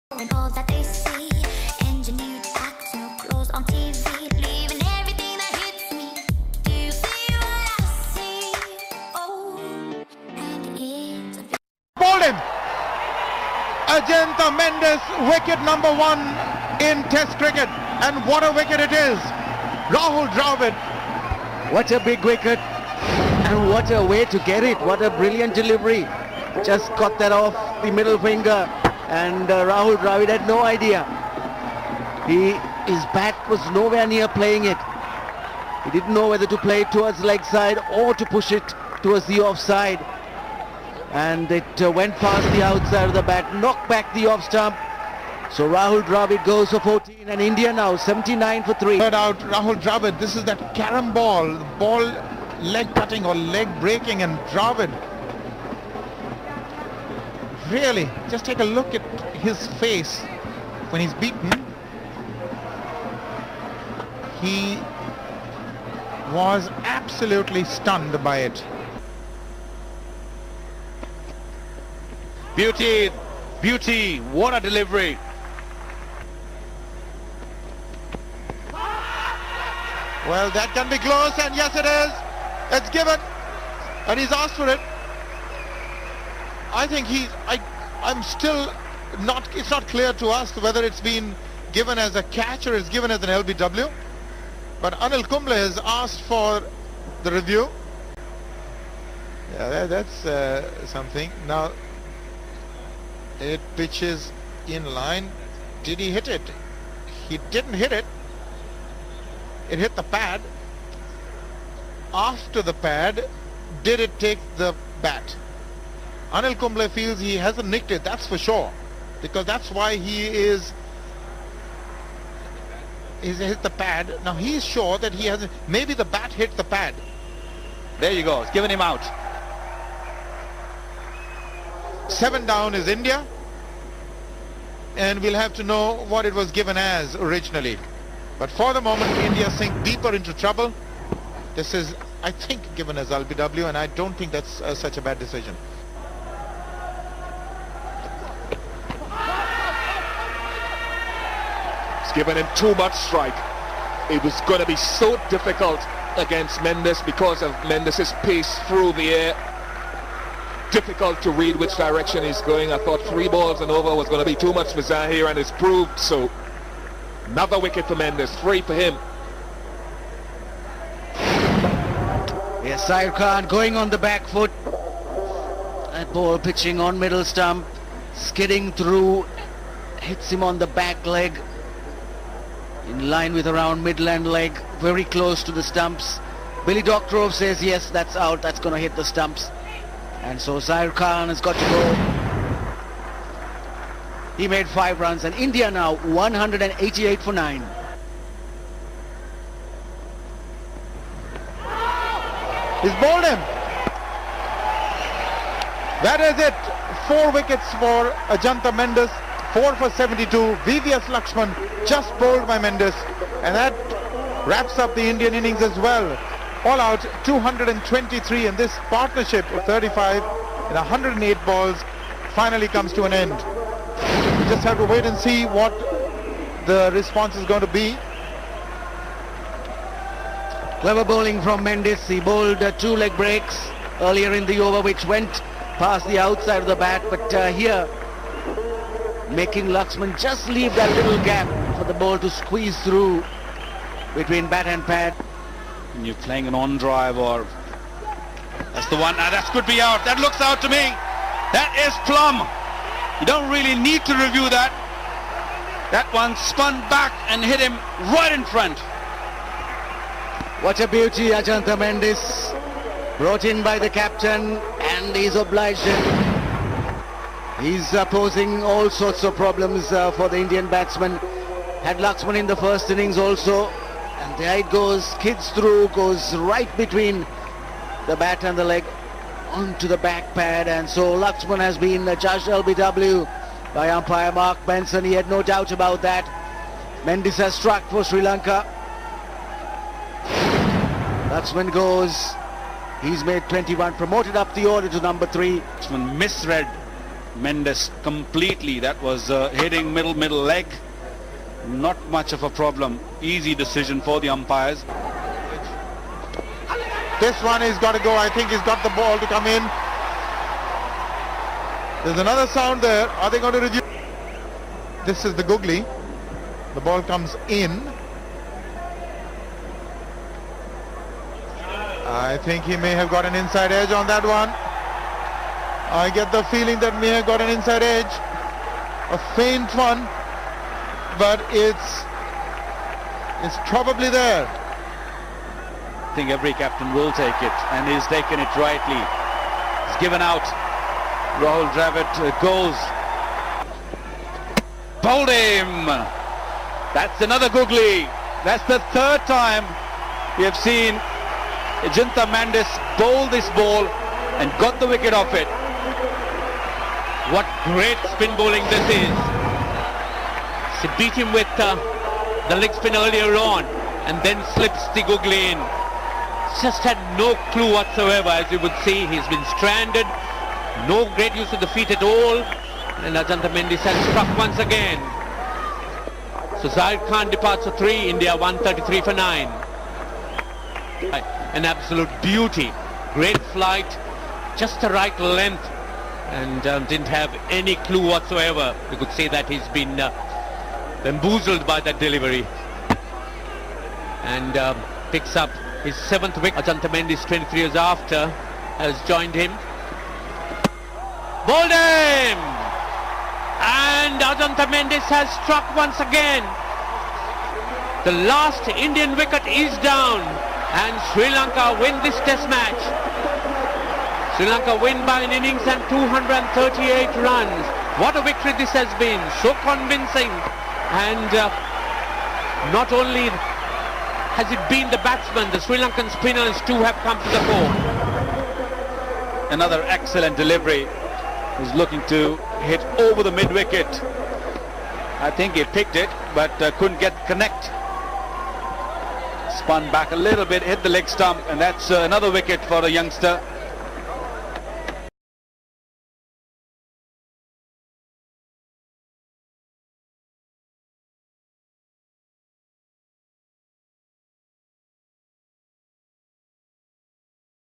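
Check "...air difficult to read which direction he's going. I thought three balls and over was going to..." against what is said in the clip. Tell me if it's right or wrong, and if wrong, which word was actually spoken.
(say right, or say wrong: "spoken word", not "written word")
right.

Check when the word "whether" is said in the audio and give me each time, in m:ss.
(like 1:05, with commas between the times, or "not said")
0:36, 1:30.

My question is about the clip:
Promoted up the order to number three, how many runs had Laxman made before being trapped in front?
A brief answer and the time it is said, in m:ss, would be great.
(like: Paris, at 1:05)
21, at 4:53.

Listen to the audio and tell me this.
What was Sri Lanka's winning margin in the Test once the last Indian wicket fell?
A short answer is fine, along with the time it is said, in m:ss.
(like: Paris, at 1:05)
An innings and 238 runs, at 6:55.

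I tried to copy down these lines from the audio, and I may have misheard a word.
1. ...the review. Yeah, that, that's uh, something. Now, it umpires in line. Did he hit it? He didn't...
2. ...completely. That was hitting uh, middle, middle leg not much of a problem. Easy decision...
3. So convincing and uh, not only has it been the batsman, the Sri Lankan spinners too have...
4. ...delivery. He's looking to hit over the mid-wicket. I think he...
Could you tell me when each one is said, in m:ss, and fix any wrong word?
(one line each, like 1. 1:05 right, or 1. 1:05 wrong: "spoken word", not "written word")
1. 1:37 wrong: "pitches", not "umpires"
2. 4:58 right
3. 6:59 right
4. 7:10 right.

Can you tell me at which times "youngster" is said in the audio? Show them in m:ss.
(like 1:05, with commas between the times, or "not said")
7:22.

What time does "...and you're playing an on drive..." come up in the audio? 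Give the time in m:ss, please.
4:05.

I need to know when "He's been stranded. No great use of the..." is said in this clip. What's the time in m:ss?
6:09.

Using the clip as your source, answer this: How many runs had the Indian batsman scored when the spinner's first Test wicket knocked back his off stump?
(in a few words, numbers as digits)
14.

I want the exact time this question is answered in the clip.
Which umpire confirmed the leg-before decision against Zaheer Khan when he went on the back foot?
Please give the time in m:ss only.
3:06.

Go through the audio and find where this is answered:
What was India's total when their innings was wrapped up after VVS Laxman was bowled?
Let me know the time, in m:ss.
3:36.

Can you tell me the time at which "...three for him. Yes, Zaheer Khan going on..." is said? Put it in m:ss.
2:48.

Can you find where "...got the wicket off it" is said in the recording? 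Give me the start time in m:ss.
5:54.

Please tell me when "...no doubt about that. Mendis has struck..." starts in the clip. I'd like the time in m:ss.
4:45.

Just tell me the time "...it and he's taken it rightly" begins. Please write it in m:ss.
5:37.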